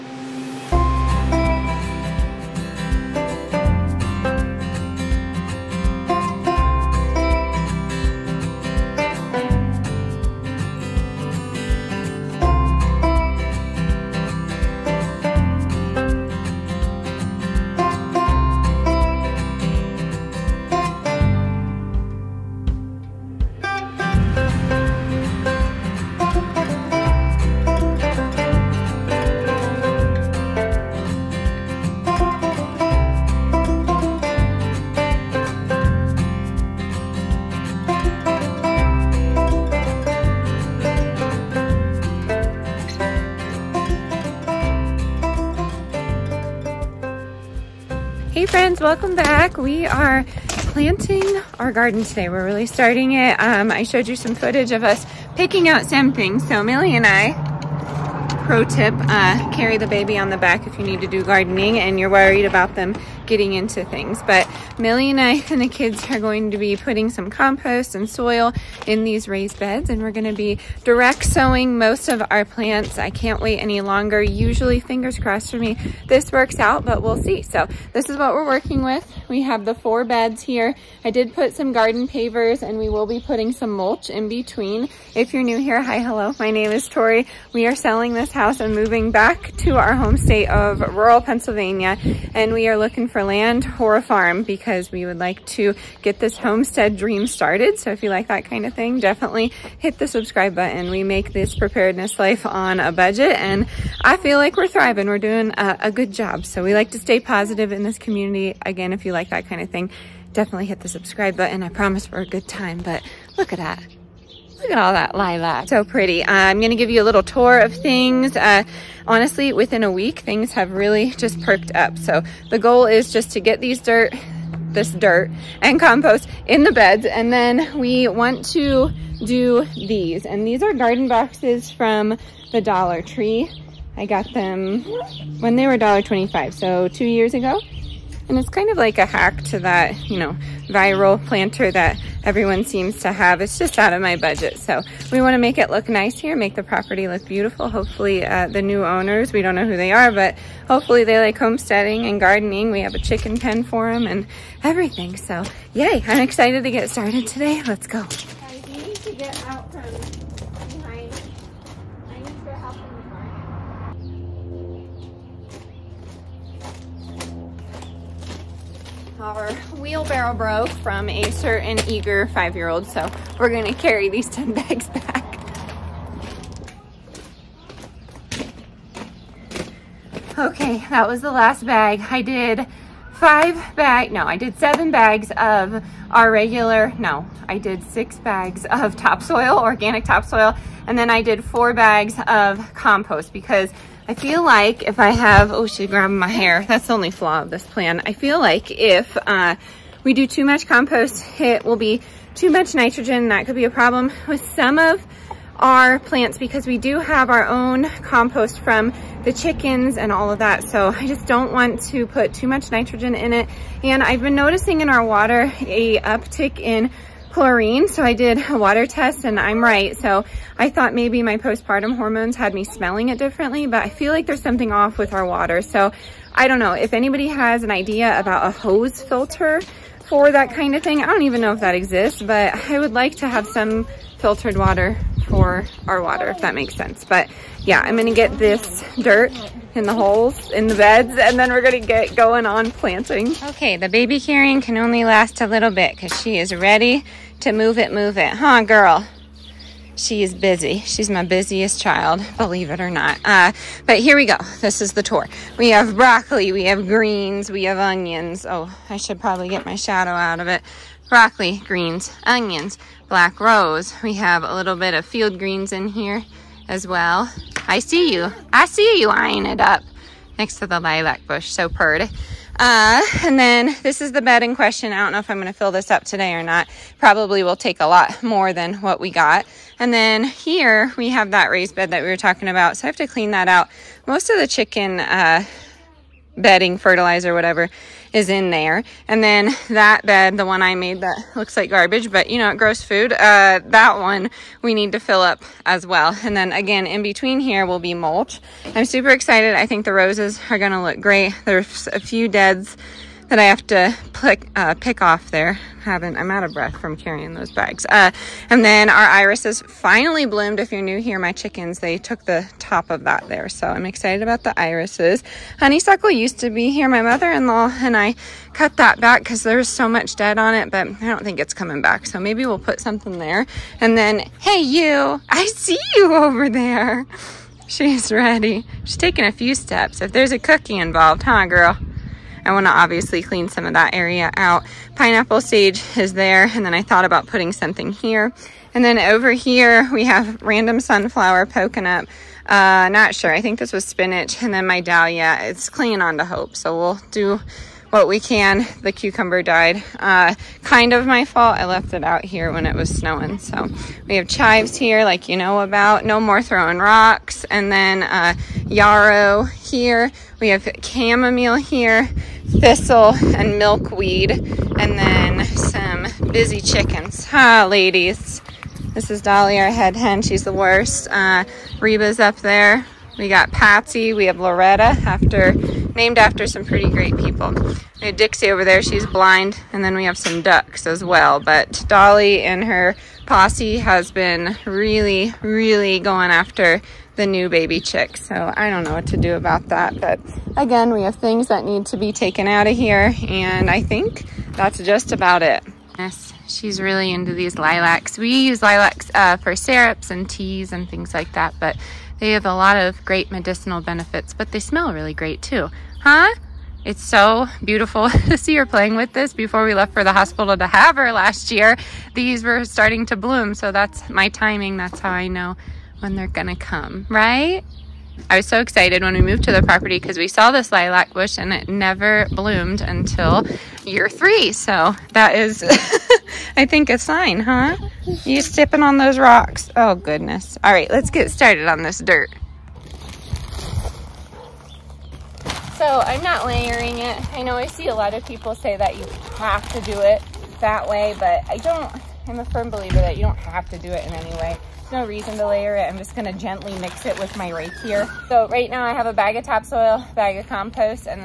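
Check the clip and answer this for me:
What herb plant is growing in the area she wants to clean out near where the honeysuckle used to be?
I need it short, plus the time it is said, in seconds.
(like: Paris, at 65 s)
pineapple sage, at 334 s.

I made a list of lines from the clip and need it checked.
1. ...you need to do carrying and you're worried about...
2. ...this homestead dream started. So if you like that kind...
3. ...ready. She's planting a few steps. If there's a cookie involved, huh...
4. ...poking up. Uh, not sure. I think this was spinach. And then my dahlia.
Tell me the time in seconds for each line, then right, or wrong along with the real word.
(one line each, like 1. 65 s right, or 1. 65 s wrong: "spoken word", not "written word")
1. 60 s wrong: "gardening", not "carrying"
2. 96 s right
3. 328 s wrong: "taking", not "planting"
4. 341 s right.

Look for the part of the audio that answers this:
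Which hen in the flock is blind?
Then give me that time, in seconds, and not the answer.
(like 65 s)
378 s.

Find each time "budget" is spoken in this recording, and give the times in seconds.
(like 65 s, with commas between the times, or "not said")
102 s, 144 s.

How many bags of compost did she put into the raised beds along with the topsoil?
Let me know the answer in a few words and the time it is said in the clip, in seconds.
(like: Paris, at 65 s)
4, at 191 s.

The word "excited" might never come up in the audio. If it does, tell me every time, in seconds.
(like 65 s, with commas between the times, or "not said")
156 s, 299 s, 313 s, 418 s.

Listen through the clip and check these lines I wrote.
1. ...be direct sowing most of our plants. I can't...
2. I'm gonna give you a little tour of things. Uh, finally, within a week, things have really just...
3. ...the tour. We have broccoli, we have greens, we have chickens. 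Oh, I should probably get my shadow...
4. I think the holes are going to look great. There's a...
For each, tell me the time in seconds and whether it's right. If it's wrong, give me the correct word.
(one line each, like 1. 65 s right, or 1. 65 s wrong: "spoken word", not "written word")
1. 70 s right
2. 116 s wrong: "honestly", not "finally"
3. 254 s wrong: "onions", not "chickens"
4. 299 s wrong: "roses", not "holes".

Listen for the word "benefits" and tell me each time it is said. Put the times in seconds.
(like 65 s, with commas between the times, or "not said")
403 s.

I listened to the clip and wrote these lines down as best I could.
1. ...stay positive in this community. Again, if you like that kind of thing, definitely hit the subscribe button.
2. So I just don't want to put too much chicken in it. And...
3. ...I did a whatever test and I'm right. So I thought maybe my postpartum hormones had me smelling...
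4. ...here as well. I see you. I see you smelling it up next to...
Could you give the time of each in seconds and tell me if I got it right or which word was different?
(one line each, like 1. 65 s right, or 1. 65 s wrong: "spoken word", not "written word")
1. 106 s right
2. 210 s wrong: "nitrogen", not "chicken"
3. 218 s wrong: "water", not "whatever"
4. 265 s wrong: "eyeing", not "smelling".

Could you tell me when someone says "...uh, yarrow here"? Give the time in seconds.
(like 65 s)
358 s.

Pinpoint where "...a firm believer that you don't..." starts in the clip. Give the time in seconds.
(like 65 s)
442 s.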